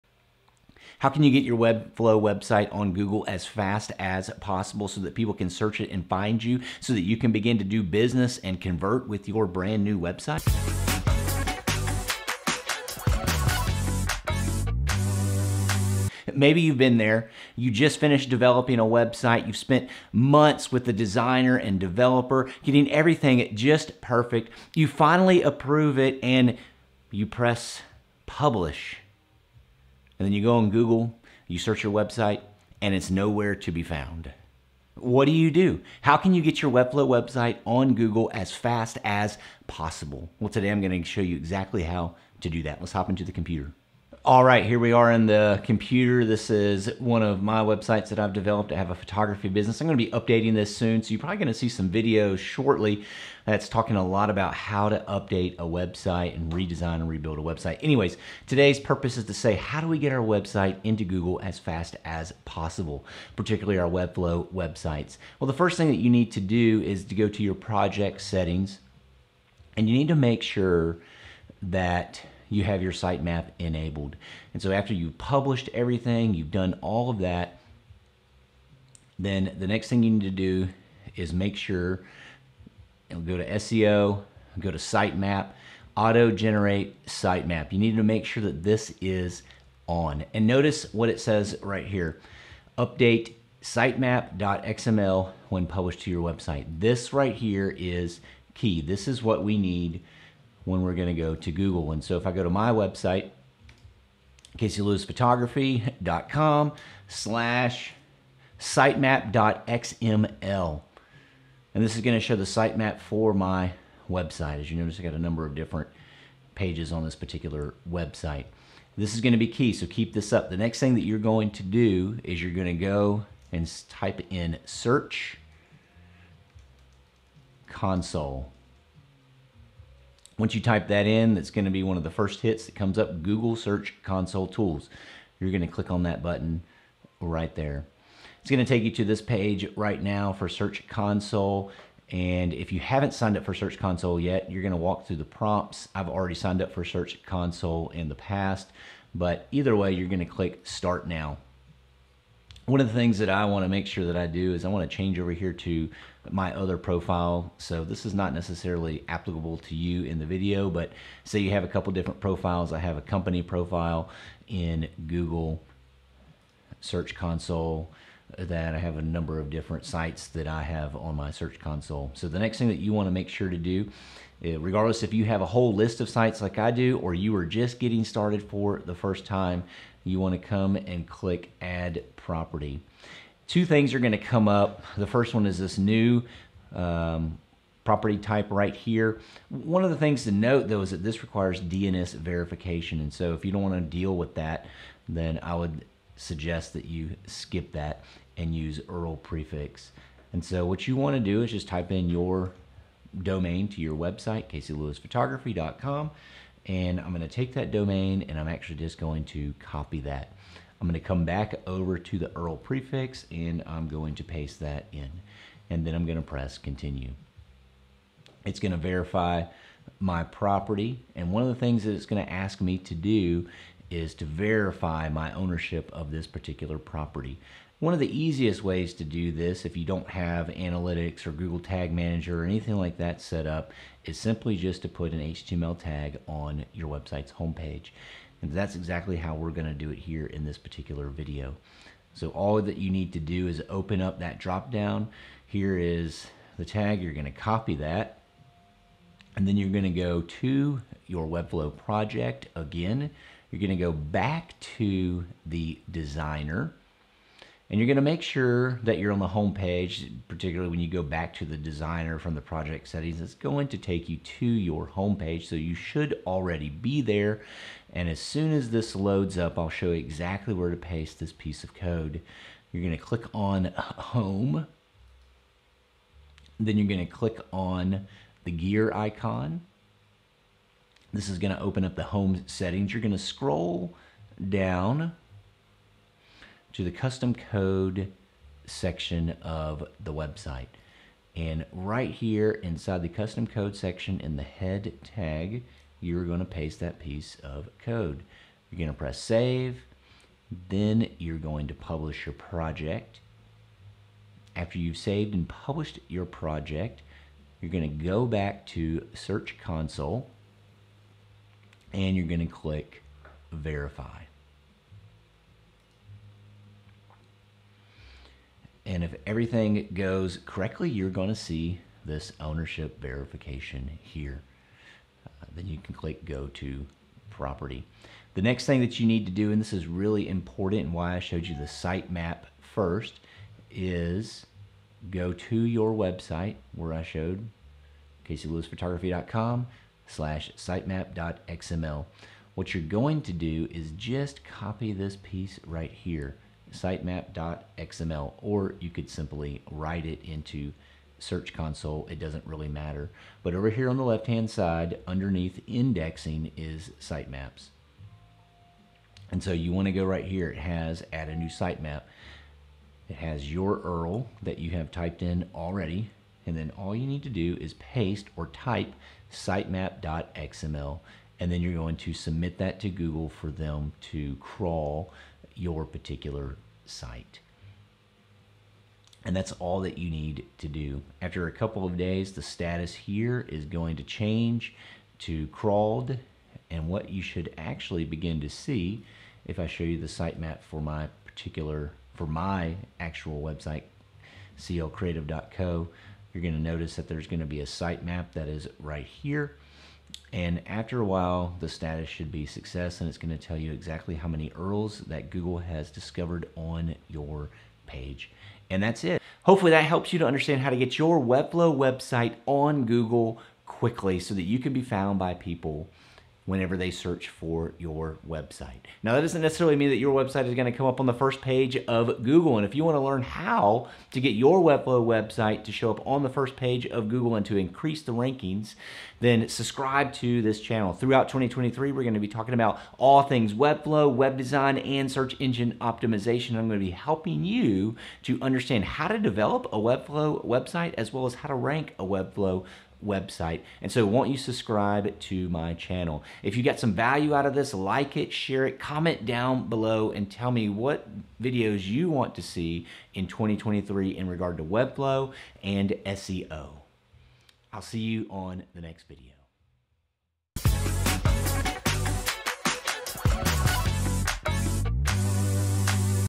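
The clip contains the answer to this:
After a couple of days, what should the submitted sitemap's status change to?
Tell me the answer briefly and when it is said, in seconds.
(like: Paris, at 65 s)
Crawled, at 385 s.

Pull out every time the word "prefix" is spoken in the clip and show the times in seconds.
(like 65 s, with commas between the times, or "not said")
199 s, 212 s.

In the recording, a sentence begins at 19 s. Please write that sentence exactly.
You've spent months with the designer and developer, getting everything just perfect.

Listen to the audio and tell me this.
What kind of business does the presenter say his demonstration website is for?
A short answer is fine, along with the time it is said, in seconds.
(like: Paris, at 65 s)
Photography, at 48 s.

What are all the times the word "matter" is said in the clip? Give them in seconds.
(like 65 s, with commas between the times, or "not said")
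352 s.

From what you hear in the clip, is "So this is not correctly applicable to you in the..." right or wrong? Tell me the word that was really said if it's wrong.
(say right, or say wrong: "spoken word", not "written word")
wrong: "necessarily", not "correctly".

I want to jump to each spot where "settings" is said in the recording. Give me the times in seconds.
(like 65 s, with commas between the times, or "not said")
68 s, 262 s, 282 s.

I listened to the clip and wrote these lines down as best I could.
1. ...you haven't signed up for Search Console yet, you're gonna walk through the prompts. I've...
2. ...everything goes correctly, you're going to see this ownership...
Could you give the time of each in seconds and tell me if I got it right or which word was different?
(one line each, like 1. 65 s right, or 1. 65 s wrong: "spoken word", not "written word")
1. 142 s right
2. 319 s right.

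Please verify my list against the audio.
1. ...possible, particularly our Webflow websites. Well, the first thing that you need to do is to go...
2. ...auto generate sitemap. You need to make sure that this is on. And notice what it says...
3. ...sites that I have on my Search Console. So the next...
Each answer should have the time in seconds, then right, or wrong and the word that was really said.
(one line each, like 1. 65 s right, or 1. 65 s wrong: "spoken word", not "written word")
1. 62 s right
2. 85 s right
3. 169 s right.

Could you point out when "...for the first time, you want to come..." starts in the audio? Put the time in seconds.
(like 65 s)
178 s.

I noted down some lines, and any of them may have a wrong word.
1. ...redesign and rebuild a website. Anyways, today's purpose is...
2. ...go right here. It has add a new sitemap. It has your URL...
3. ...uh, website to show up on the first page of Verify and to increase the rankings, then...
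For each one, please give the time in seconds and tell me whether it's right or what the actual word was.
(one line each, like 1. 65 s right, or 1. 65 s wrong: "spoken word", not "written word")
1. 56 s right
2. 359 s right
3. 425 s wrong: "Google", not "Verify".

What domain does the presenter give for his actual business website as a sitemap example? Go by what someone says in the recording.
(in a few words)
clcreative.co.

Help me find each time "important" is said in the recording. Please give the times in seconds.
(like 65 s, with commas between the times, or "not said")
330 s.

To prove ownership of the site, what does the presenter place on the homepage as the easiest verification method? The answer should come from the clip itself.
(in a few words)
HTML tag.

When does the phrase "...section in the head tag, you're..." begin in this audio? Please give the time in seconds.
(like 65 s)
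293 s.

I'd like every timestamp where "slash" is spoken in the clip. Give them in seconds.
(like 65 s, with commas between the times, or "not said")
107 s, 340 s.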